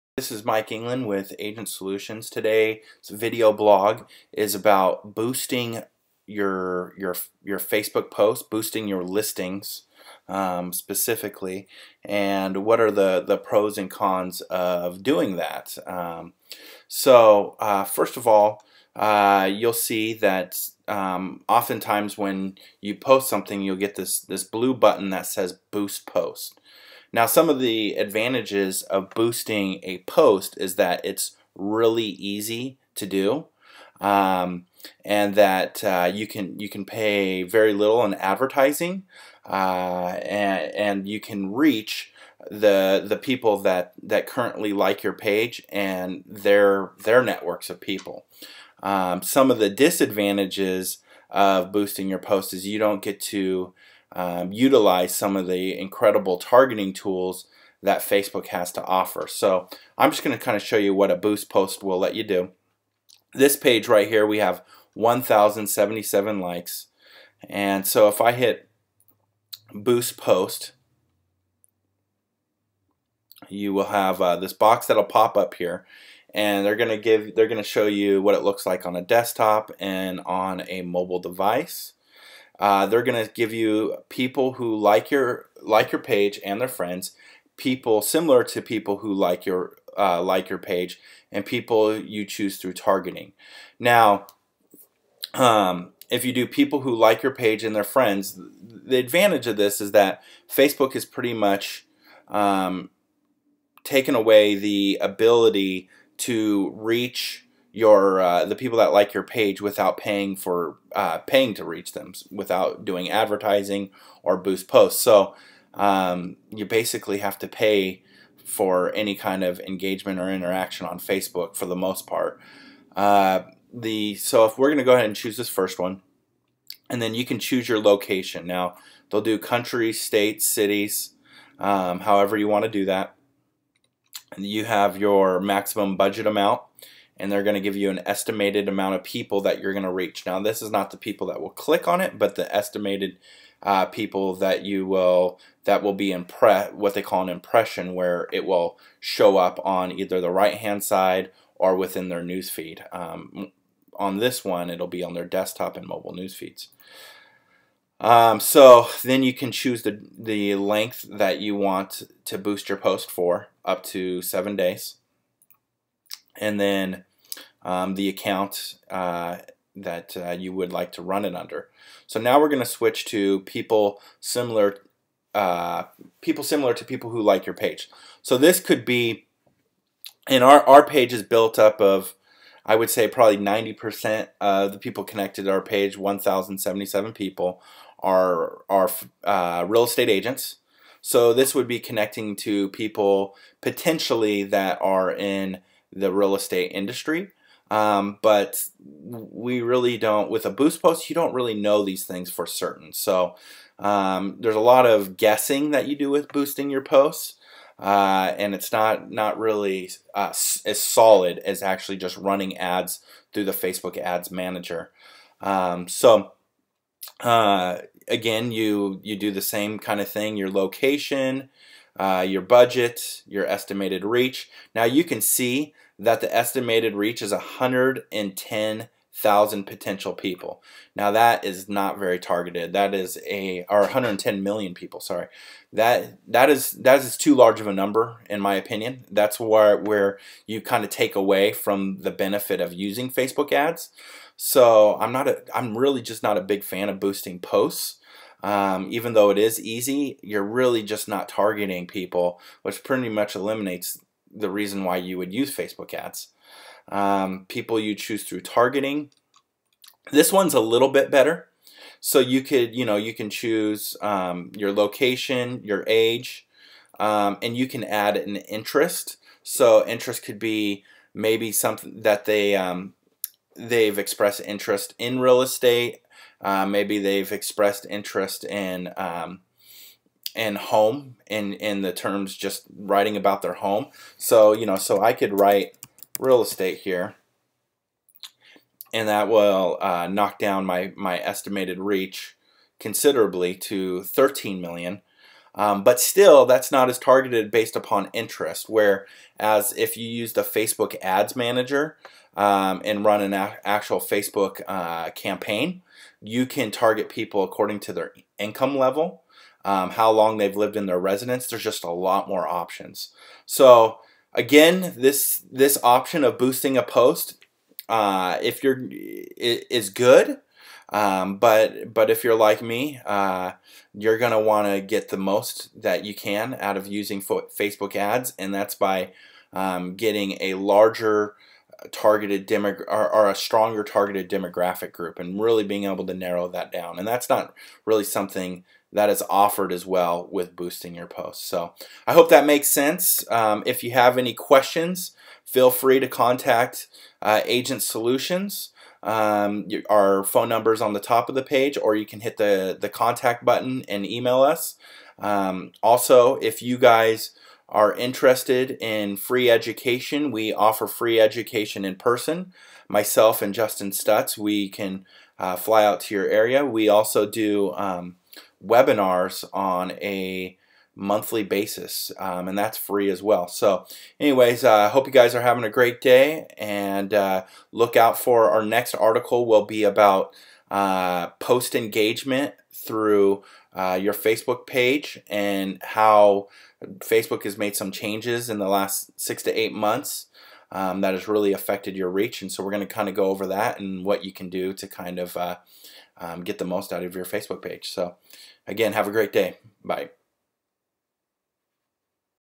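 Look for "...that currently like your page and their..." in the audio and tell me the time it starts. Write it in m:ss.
0:44.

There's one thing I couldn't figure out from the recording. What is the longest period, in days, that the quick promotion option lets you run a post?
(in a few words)
7 days.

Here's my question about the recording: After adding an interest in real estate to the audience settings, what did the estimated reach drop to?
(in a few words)
13 million.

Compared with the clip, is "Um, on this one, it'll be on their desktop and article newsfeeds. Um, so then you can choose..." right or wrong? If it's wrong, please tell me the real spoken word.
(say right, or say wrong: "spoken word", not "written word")
wrong: "mobile", not "article".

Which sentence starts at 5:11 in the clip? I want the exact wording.
There's just a lot more options.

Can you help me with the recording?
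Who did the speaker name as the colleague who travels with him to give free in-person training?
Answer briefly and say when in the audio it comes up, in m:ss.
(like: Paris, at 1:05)
Justin Stutz, at 6:03.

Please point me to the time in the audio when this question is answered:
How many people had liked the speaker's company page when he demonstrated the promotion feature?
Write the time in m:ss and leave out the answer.
1:04.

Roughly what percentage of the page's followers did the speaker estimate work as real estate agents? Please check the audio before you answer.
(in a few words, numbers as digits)
90%.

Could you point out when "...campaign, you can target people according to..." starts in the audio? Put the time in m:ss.
5:05.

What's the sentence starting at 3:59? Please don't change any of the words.
That's where where you kind of take away from the benefit of using Facebook ads.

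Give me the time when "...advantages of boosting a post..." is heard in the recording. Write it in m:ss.
0:27.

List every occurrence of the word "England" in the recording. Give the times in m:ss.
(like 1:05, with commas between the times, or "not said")
0:00.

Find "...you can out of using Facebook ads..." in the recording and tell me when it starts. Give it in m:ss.
5:26.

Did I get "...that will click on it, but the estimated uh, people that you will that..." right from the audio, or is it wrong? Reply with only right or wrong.
right.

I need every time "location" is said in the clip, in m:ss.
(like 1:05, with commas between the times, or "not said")
2:07, 3:40, 4:24.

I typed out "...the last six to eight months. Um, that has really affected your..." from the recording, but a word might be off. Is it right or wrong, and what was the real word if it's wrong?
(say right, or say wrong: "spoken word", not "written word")
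right.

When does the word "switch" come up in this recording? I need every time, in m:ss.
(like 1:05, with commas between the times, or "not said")
2:52.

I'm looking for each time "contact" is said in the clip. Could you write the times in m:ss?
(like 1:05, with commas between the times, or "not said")
5:46, 5:52.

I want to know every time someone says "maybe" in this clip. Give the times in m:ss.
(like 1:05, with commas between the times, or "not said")
4:31, 4:36.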